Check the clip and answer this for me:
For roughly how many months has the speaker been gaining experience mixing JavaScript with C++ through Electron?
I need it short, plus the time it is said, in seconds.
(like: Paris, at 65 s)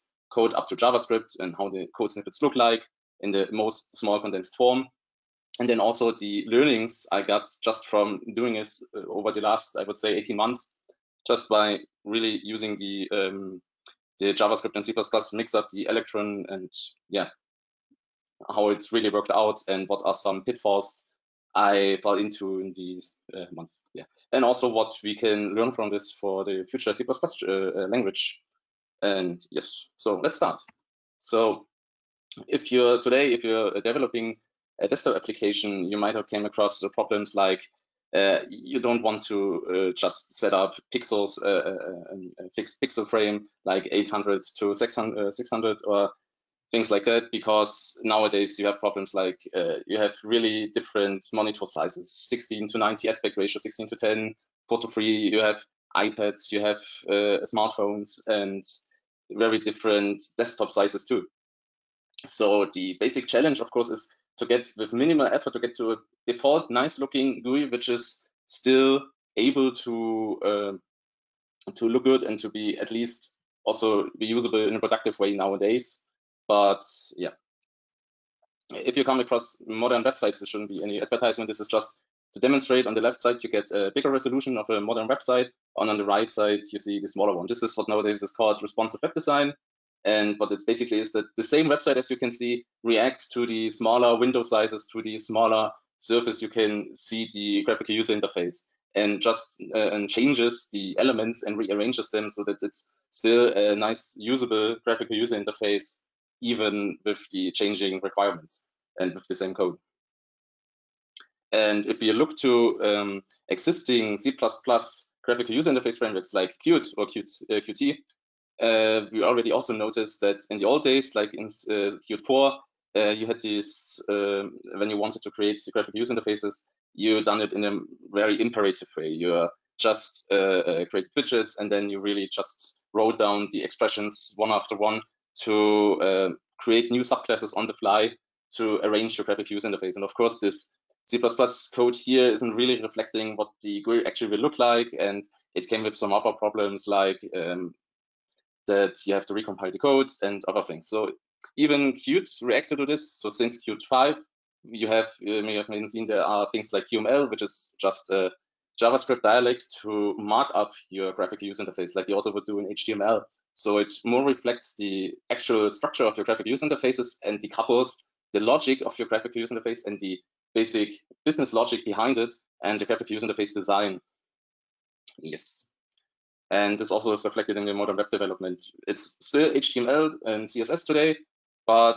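18, at 10 s.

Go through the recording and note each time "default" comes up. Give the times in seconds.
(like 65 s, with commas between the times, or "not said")
66 s.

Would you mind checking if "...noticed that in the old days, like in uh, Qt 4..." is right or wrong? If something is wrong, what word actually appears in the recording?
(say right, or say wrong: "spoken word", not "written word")
right.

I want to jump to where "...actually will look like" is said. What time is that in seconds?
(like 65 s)
144 s.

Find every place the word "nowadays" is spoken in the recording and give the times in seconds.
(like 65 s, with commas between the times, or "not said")
48 s, 75 s, 87 s.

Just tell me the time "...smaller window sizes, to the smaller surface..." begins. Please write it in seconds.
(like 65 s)
93 s.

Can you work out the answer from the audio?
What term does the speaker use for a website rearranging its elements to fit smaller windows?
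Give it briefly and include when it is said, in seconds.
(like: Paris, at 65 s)
responsive web design, at 88 s.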